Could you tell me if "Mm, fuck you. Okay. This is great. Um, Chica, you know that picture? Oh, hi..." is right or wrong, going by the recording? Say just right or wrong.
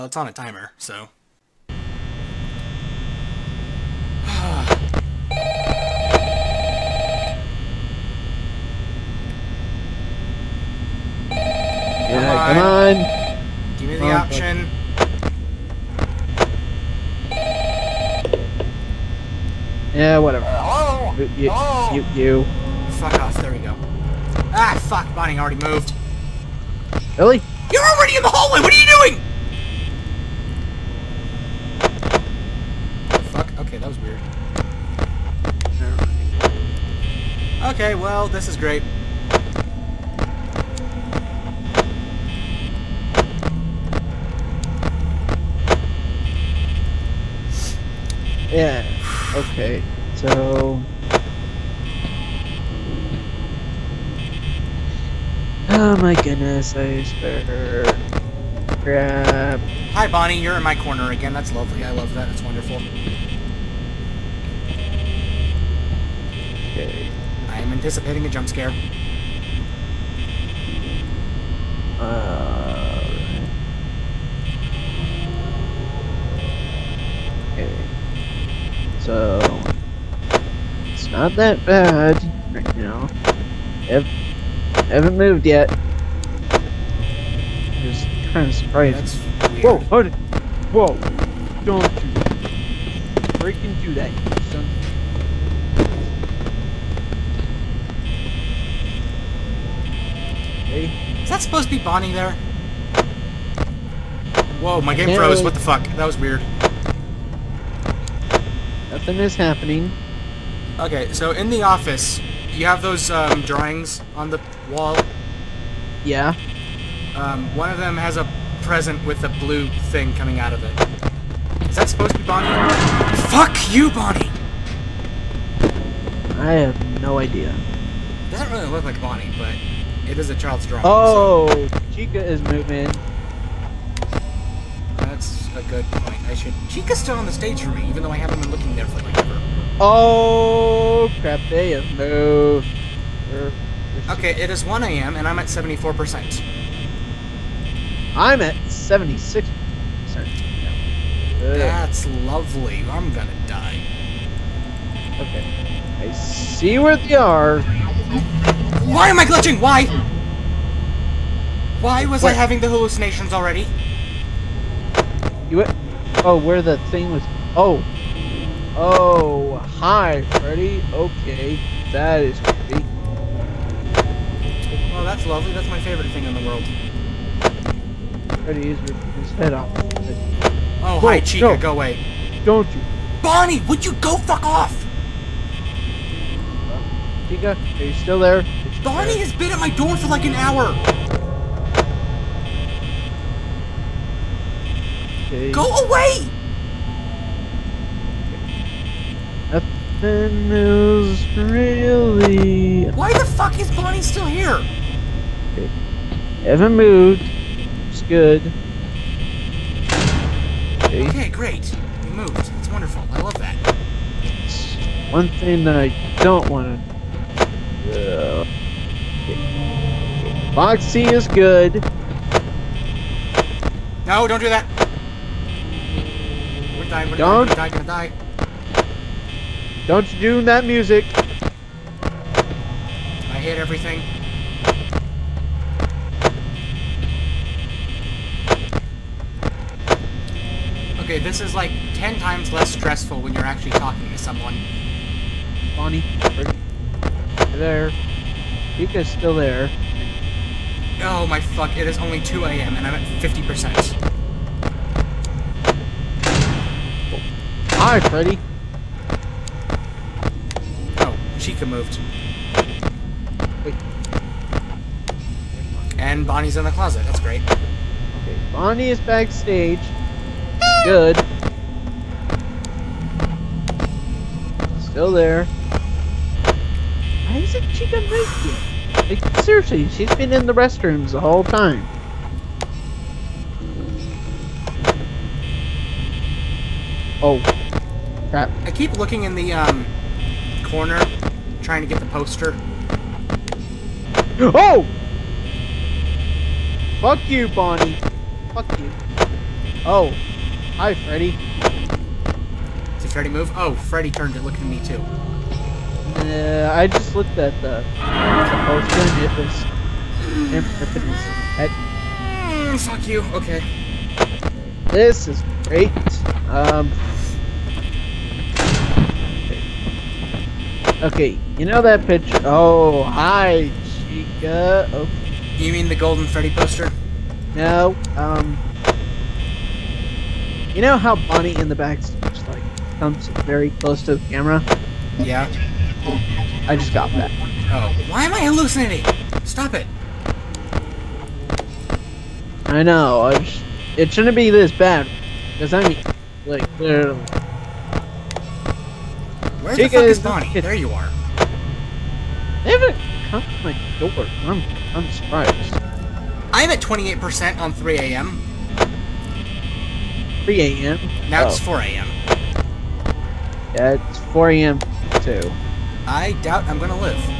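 wrong.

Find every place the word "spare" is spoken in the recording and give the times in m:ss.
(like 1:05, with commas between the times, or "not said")
0:57.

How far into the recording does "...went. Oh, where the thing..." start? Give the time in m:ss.
2:45.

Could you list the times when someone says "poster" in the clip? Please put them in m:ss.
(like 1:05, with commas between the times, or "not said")
4:52, 5:26.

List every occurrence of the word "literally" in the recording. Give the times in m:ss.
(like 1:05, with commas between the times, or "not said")
5:46.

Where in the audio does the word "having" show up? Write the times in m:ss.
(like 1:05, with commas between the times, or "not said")
2:42.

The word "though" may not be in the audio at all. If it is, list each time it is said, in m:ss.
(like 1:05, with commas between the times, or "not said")
2:18.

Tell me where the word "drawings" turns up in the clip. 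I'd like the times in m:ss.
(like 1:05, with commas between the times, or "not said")
1:53, 2:10.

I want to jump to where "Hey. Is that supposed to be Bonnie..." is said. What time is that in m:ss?
1:40.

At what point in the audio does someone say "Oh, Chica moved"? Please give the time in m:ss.
4:20.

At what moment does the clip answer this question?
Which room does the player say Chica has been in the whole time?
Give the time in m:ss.
4:40.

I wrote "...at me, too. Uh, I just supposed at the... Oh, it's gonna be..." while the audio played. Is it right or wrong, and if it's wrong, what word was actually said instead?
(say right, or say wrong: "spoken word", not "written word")
wrong: "looked", not "supposed".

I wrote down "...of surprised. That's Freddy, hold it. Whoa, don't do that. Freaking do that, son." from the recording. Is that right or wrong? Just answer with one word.
wrong.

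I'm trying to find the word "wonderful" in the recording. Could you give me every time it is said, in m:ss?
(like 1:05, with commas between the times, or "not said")
1:02, 3:32.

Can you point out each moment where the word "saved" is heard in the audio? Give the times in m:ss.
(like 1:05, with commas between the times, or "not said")
not said.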